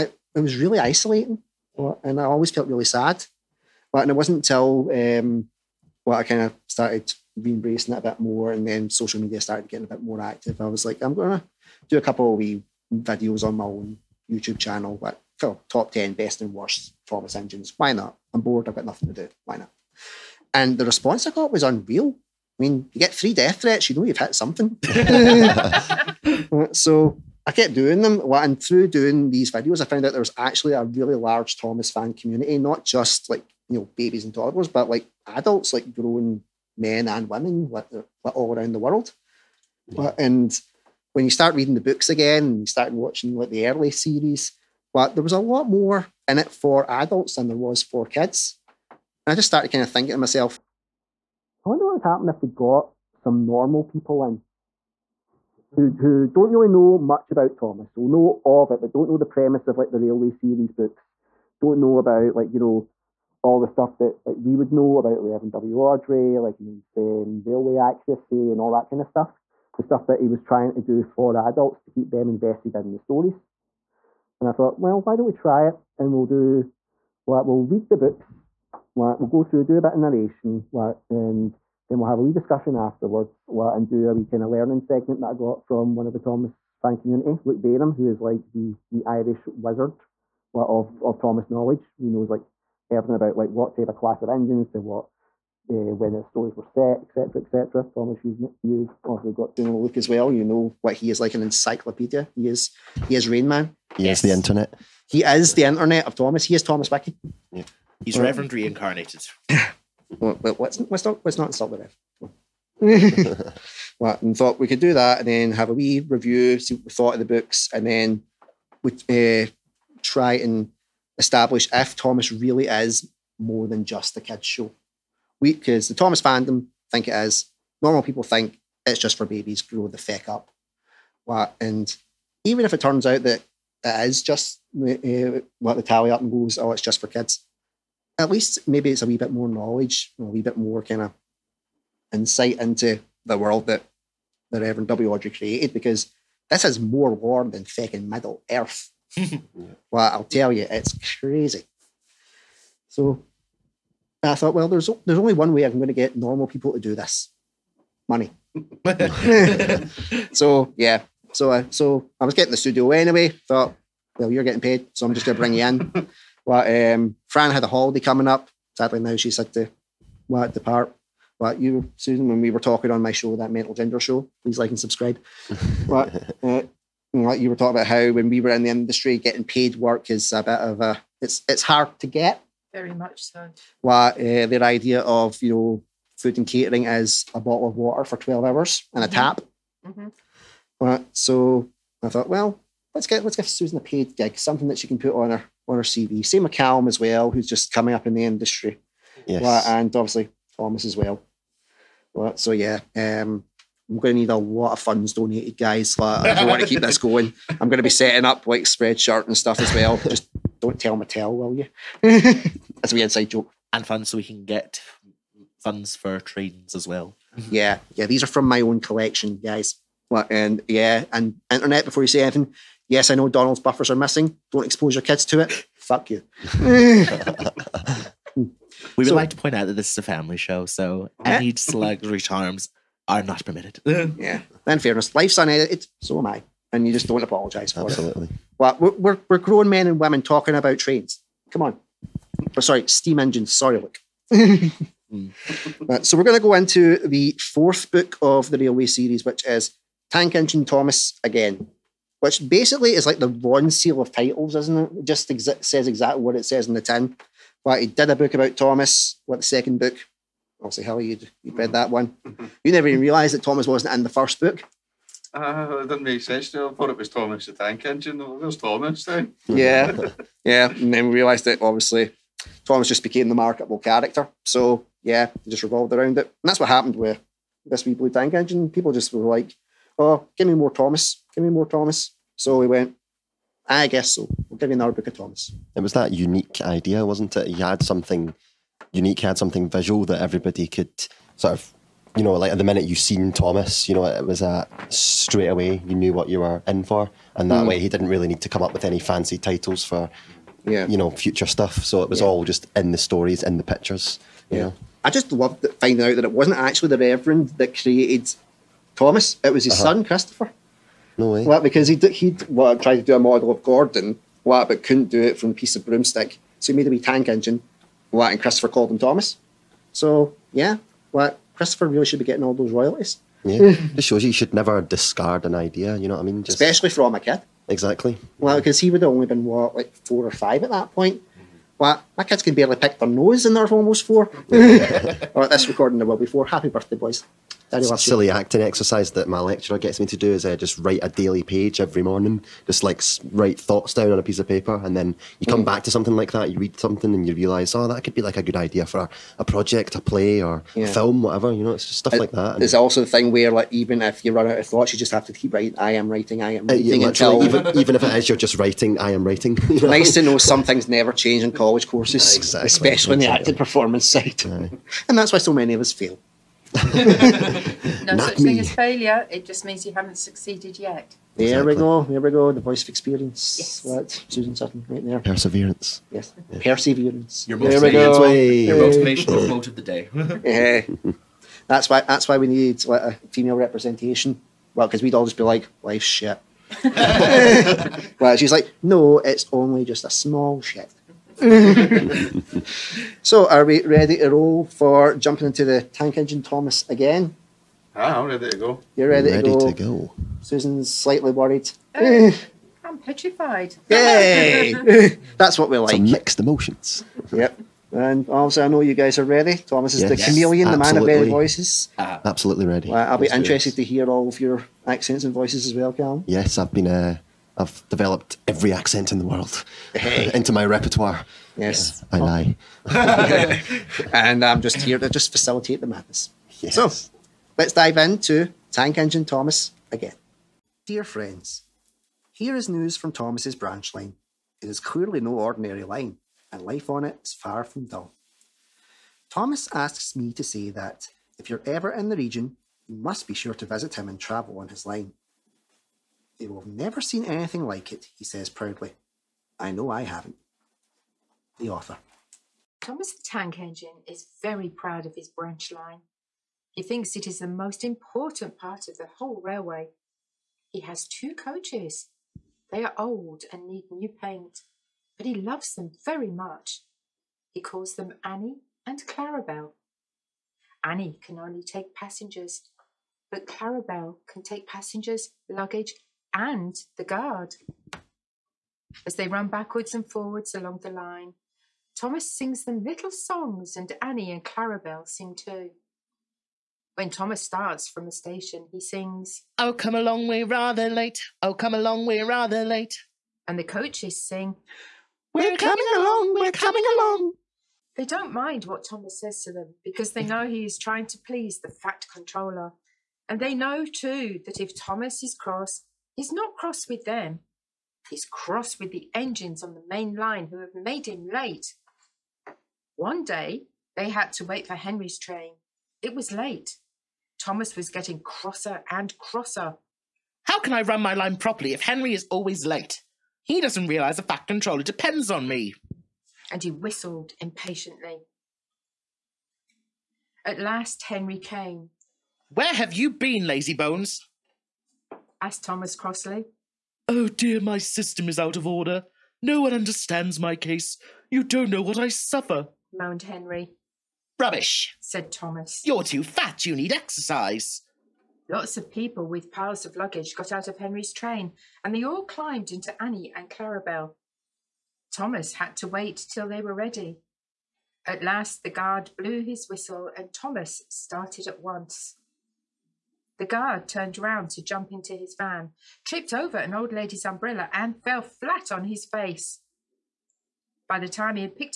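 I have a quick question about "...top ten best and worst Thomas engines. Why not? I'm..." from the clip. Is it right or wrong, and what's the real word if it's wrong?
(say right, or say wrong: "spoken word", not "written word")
right.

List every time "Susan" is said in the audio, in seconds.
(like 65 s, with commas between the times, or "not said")
171 s, 193 s, 374 s, 400 s.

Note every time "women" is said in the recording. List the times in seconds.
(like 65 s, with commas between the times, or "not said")
37 s, 239 s.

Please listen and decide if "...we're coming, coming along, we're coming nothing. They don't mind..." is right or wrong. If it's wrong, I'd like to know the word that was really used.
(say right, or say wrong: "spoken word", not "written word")
wrong: "along", not "nothing".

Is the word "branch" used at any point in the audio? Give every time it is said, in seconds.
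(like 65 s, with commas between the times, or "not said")
433 s, 455 s.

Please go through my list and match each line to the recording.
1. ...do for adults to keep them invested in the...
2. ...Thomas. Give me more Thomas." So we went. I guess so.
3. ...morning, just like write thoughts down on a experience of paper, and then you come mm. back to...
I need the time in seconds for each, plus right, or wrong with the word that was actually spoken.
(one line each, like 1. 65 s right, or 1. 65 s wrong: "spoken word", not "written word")
1. 70 s right
2. 280 s right
3. 342 s wrong: "piece", not "experience".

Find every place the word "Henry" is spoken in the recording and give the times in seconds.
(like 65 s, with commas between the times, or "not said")
514 s, 521 s, 531 s, 543 s, 550 s.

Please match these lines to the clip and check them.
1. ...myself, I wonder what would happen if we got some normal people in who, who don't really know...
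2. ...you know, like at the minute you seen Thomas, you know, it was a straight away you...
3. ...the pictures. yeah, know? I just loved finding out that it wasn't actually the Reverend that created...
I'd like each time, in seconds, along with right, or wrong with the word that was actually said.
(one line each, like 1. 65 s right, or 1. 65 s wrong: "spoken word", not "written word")
1. 50 s right
2. 292 s right
3. 303 s right.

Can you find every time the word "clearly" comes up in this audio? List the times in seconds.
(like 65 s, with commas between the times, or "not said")
434 s.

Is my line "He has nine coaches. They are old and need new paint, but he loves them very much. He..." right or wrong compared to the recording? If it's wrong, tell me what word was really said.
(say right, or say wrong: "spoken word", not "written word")
wrong: "two", not "nine".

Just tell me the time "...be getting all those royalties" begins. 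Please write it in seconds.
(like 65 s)
322 s.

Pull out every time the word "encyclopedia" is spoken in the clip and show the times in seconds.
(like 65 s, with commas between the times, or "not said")
101 s.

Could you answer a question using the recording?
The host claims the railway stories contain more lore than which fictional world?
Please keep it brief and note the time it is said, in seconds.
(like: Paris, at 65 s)
Middle Earth, at 148 s.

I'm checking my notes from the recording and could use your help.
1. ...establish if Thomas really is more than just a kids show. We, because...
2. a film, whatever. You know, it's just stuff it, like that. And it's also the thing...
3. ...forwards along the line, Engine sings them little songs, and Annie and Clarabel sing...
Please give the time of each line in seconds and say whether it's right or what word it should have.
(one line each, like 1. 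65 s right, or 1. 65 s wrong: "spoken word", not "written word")
1. 121 s right
2. 350 s right
3. 480 s wrong: "Thomas", not "Engine".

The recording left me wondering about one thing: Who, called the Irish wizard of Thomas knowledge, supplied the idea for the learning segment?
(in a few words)
Luke Bainham.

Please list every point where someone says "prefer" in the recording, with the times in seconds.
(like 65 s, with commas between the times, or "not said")
not said.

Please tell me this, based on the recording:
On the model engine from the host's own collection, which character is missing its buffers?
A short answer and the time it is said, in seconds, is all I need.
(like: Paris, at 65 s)
Donald, at 223 s.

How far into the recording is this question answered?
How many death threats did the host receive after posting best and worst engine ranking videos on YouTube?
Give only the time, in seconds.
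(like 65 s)
23 s.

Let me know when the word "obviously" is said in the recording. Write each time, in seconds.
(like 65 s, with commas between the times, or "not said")
99 s, 199 s, 260 s, 271 s, 408 s.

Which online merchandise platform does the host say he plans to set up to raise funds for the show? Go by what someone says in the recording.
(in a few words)
Spreadshirt.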